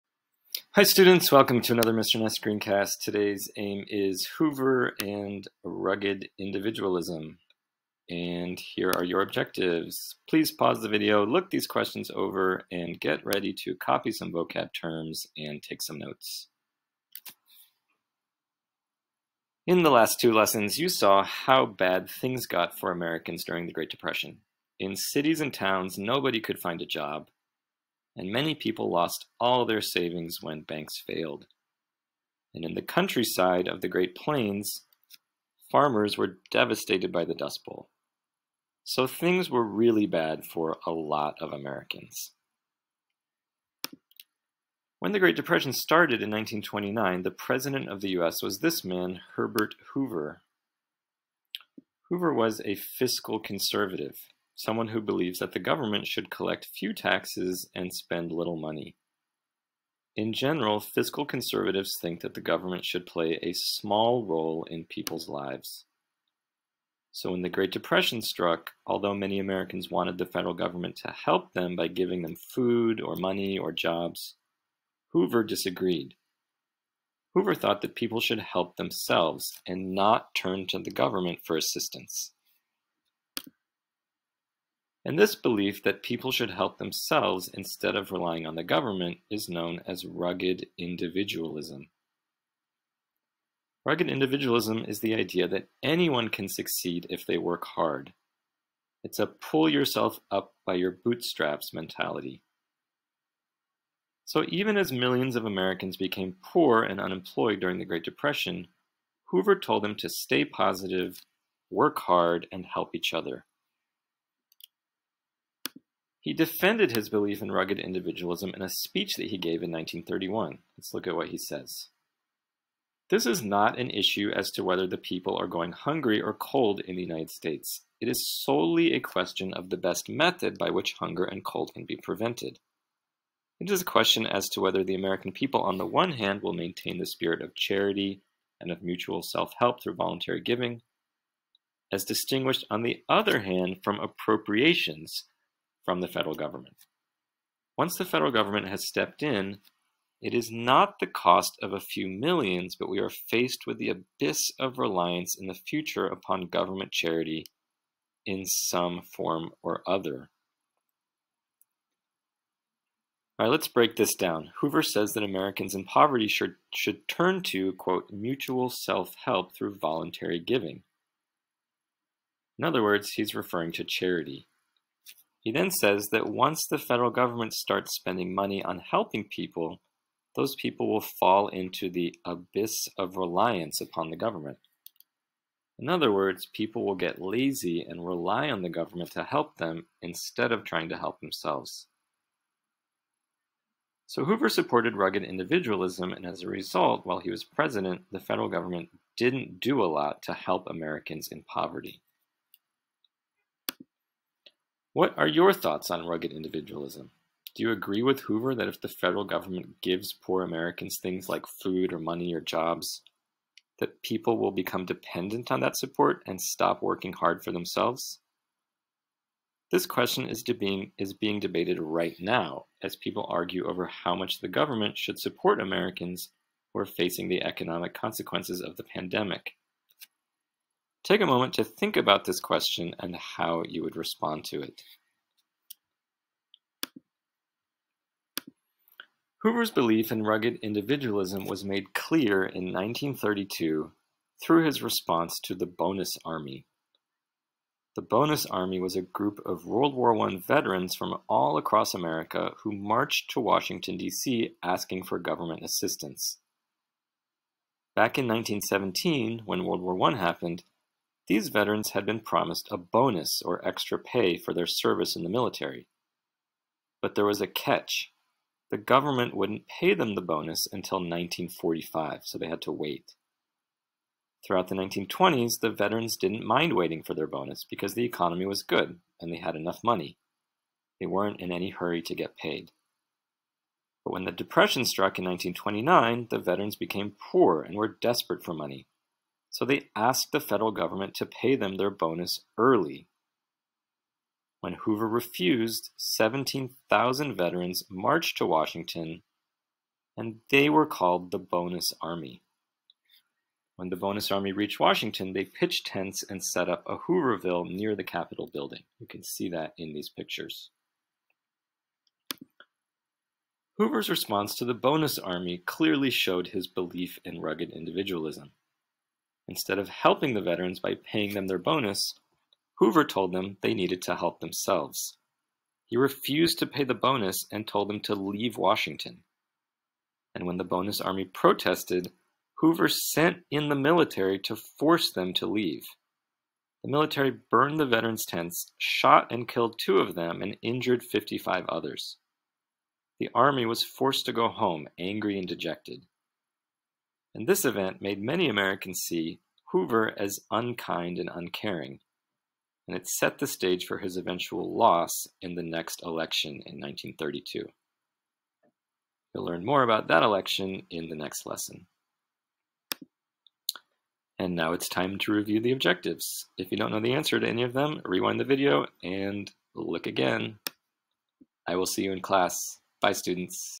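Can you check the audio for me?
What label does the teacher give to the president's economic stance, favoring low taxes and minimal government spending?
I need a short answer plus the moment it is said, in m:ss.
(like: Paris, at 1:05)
fiscal conservative, at 0:52.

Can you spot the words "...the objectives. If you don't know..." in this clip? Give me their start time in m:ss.
6:05.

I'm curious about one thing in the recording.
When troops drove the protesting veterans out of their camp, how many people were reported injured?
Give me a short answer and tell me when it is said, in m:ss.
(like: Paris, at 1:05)
55, at 5:41.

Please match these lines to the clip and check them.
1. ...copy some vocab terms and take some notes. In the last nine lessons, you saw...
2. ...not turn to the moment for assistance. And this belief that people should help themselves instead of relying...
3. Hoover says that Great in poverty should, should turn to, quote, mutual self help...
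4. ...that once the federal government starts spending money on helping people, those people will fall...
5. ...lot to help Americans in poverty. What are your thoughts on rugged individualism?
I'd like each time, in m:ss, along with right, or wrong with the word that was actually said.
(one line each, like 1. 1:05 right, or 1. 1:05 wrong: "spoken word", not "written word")
1. 0:13 wrong: "two", not "nine"
2. 1:19 wrong: "government", not "moment"
3. 2:44 wrong: "Americans", not "Great"
4. 2:56 right
5. 3:19 right.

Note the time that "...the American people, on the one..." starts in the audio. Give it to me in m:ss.
2:14.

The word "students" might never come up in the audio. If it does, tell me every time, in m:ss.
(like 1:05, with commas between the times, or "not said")
0:00, 6:13.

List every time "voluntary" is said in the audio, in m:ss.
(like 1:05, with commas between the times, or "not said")
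2:19, 2:49.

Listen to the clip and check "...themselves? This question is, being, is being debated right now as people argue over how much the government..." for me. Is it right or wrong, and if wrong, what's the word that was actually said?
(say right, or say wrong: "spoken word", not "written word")
right.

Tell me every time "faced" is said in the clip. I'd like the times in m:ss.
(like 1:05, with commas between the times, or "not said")
2:33.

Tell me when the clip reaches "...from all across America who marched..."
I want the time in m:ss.
4:10.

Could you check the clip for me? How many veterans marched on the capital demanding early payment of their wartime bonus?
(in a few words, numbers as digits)
17,000.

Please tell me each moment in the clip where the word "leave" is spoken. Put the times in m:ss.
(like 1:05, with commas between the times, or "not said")
5:28, 5:35.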